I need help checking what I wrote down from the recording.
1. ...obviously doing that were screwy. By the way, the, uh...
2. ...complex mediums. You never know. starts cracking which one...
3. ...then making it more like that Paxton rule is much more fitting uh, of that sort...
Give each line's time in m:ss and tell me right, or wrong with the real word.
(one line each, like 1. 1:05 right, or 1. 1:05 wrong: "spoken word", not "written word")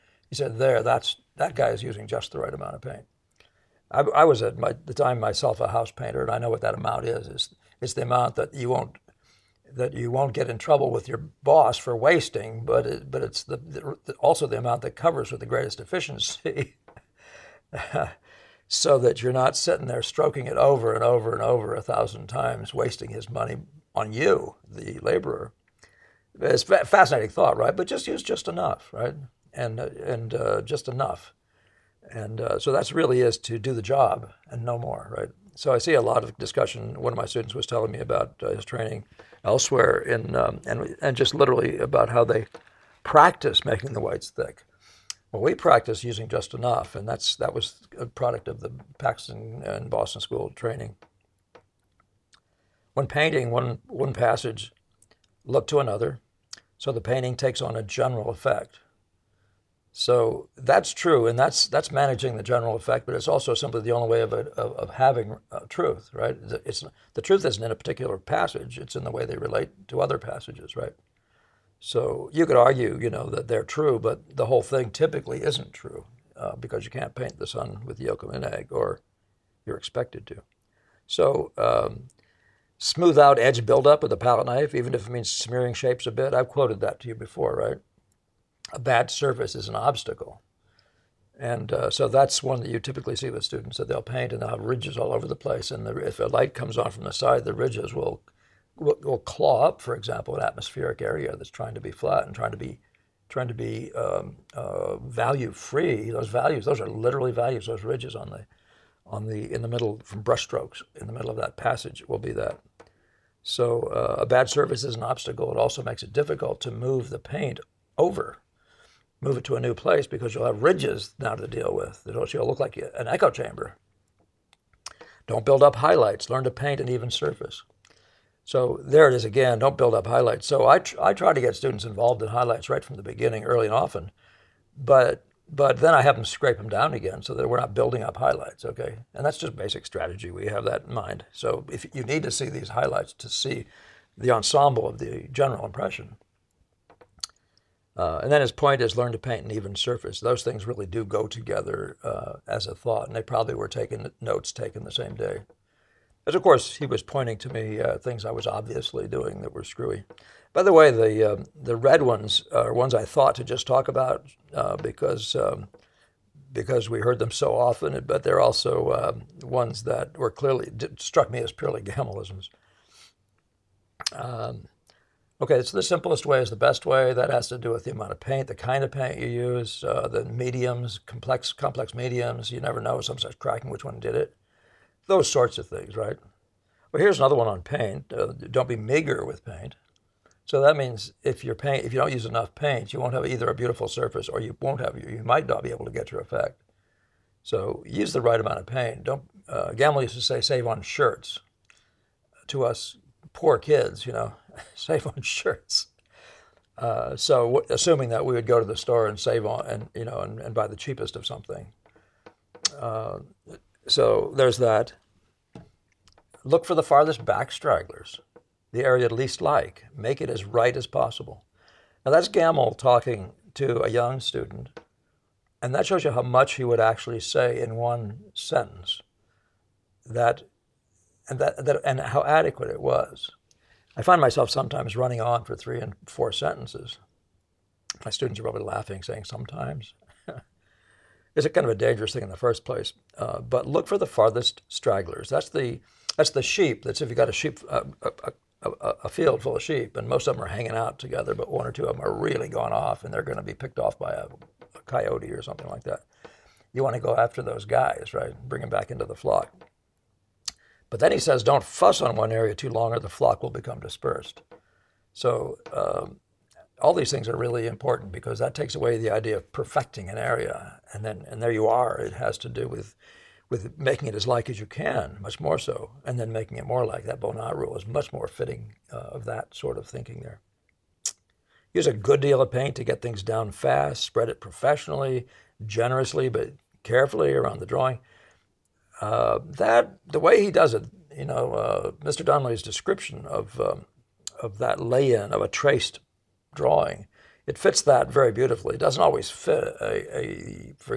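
1. 2:38 right
2. 3:01 right
3. 4:36 wrong: "Bonnard", not "Paxton".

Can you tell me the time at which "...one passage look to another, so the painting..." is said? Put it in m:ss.
0:53.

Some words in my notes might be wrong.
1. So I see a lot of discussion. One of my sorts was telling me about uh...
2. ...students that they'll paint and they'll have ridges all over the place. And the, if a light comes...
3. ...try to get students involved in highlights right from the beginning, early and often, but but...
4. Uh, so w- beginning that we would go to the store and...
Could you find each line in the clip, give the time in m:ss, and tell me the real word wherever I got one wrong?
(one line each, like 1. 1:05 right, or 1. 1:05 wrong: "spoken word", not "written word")
1. 0:35 wrong: "students", not "sorts"
2. 1:33 right
3. 2:11 right
4. 3:26 wrong: "assuming", not "beginning".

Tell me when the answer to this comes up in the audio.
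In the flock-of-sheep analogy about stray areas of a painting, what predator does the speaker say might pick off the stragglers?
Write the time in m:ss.
4:14.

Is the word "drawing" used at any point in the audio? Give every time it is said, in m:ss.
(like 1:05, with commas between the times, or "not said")
4:47, 4:56.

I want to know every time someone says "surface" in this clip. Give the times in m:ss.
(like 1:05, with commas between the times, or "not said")
1:29, 1:54, 2:07, 2:29, 3:13.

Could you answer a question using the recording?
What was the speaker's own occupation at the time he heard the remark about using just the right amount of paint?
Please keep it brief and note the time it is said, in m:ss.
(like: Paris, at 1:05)
House painter, at 0:05.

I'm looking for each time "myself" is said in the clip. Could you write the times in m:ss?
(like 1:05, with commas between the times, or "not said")
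0:05, 3:54.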